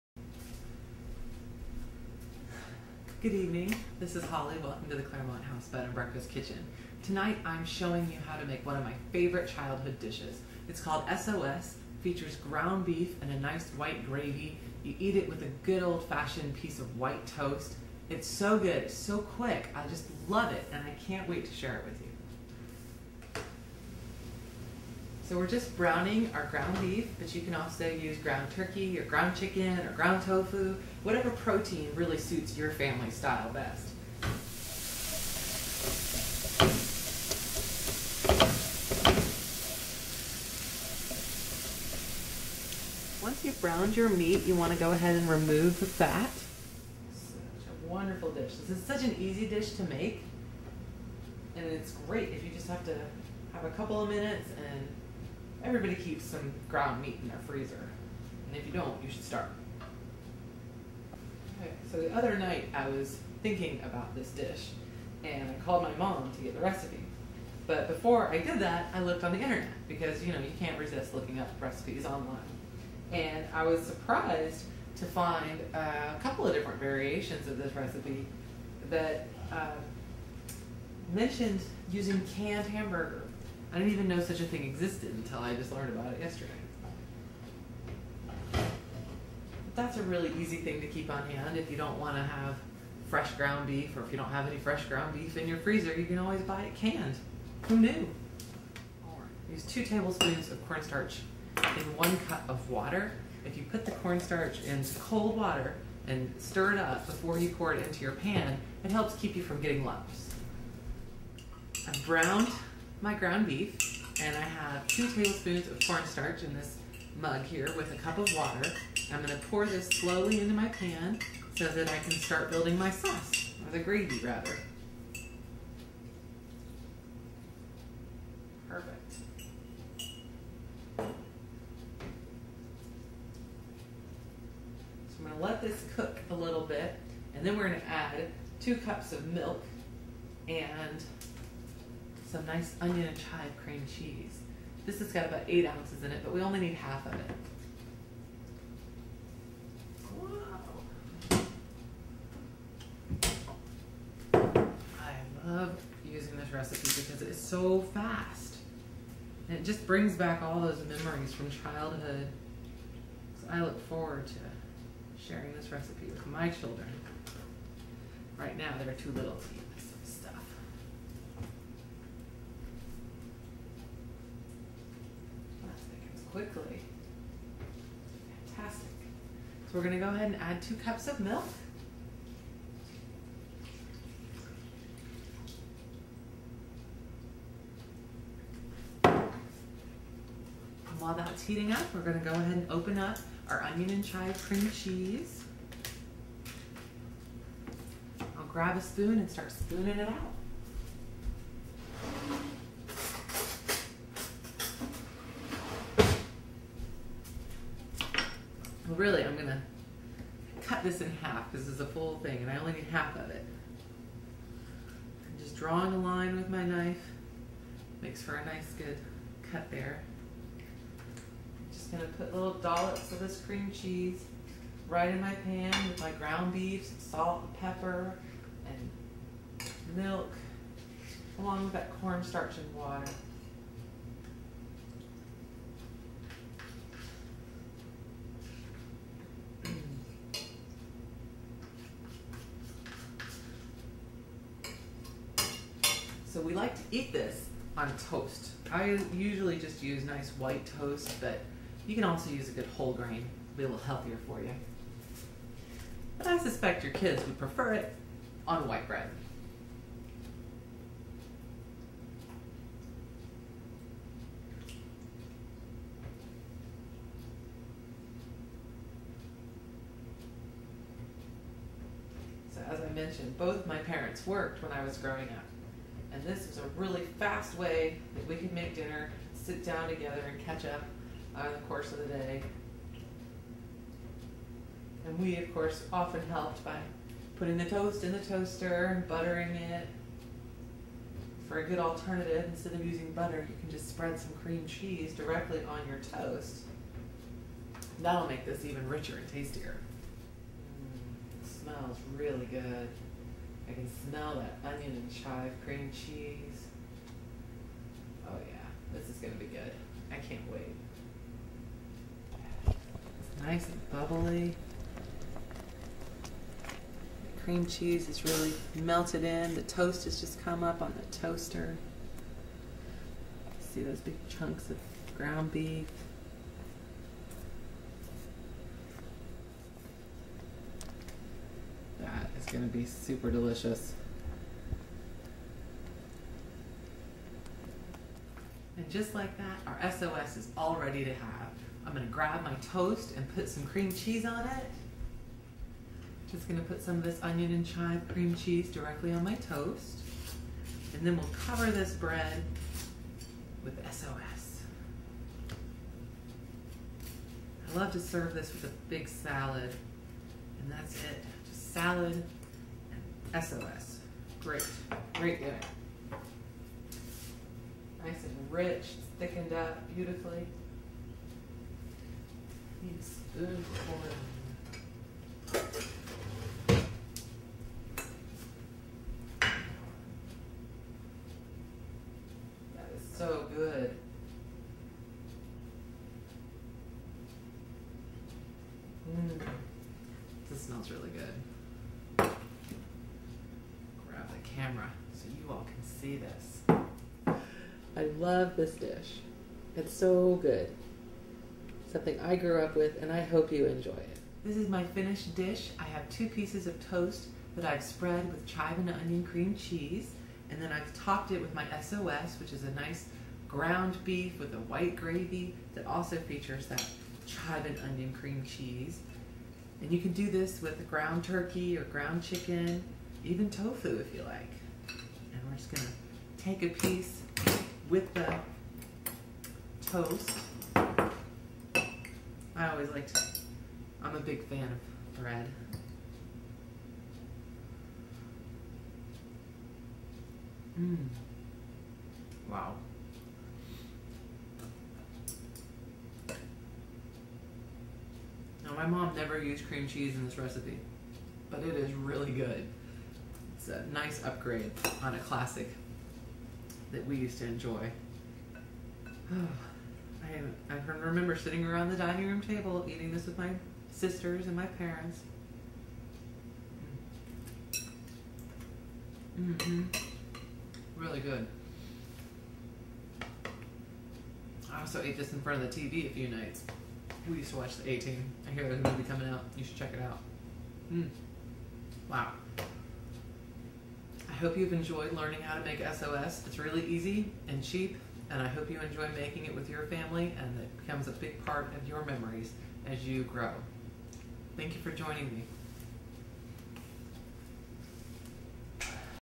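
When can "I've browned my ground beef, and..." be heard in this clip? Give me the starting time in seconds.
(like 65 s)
111 s.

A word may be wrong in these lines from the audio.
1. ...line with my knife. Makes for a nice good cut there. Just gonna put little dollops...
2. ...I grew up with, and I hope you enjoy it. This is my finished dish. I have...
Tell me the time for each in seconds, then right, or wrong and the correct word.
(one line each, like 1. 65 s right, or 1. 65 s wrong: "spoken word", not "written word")
1. 215 s right
2. 402 s right.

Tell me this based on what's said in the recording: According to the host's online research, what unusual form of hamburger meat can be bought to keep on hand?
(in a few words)
Canned hamburger.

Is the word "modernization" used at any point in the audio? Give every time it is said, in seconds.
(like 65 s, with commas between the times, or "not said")
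not said.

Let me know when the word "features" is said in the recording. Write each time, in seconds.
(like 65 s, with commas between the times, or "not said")
12 s, 416 s.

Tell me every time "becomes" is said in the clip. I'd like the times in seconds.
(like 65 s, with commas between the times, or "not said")
490 s.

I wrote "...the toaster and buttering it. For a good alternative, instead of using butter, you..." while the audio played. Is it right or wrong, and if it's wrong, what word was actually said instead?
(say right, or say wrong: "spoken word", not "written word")
right.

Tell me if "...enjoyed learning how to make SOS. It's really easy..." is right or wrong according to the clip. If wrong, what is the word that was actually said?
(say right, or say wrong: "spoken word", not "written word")
right.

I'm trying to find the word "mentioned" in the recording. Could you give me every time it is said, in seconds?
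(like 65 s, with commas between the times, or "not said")
81 s, 272 s.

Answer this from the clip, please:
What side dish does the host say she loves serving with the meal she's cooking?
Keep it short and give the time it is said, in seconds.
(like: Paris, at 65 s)
A big salad, at 358 s.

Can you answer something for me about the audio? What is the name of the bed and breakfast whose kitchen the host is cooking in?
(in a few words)
Claremont House.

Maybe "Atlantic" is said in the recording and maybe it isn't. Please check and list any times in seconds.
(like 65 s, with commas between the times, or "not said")
not said.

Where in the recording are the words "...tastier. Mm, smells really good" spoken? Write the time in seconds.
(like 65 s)
299 s.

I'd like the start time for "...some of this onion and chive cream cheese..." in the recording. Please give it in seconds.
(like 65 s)
346 s.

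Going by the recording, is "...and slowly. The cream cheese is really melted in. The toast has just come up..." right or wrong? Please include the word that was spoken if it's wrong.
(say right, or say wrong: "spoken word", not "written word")
wrong: "bubbly", not "slowly".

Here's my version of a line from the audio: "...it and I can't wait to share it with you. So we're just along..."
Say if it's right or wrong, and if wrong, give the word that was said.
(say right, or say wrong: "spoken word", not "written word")
wrong: "browning", not "along".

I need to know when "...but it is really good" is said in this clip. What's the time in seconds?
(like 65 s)
451 s.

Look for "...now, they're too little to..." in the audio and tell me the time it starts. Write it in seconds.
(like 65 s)
168 s.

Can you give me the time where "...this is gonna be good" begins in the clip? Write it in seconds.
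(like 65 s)
308 s.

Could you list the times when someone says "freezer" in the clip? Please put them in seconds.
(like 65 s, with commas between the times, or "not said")
57 s, 95 s.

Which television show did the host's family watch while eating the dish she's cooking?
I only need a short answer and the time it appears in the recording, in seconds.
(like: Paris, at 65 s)
The A Team, at 477 s.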